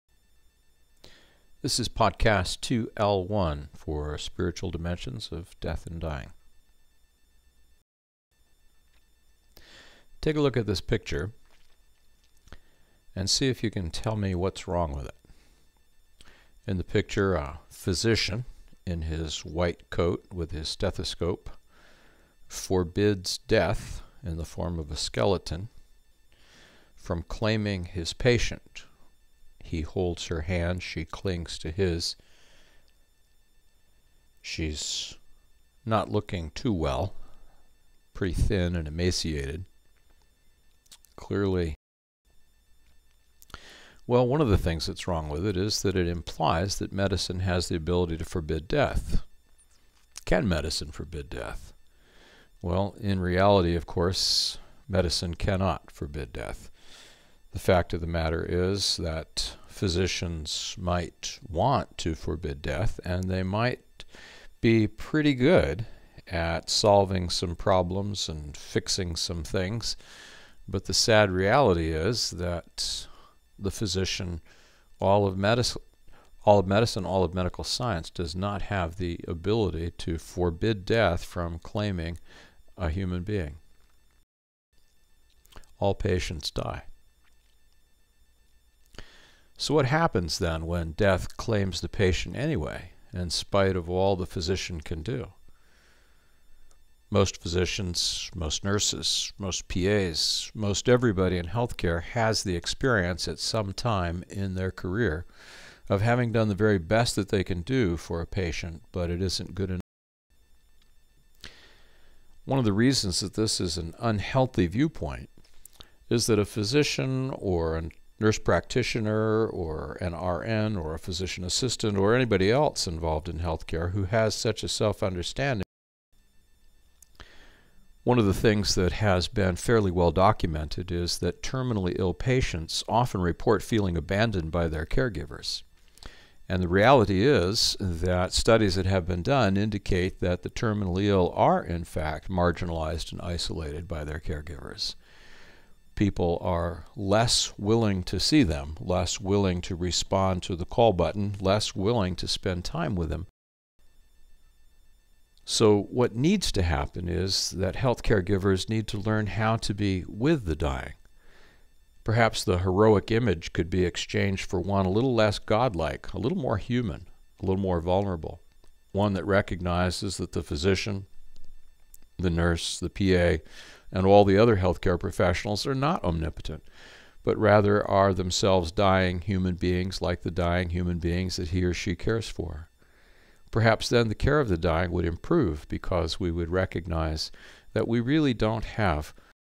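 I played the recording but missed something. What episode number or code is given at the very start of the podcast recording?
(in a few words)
2L1.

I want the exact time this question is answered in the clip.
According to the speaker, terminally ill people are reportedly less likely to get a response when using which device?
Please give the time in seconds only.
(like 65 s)
150 s.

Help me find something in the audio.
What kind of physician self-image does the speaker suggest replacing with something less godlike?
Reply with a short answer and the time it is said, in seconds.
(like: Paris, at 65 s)
Heroic, at 162 s.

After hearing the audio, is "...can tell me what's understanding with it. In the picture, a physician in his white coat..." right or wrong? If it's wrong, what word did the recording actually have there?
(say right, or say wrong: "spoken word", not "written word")
wrong: "wrong", not "understanding".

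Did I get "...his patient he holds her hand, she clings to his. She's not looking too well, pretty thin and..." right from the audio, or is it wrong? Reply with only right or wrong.
right.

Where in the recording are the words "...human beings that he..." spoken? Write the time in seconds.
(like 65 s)
180 s.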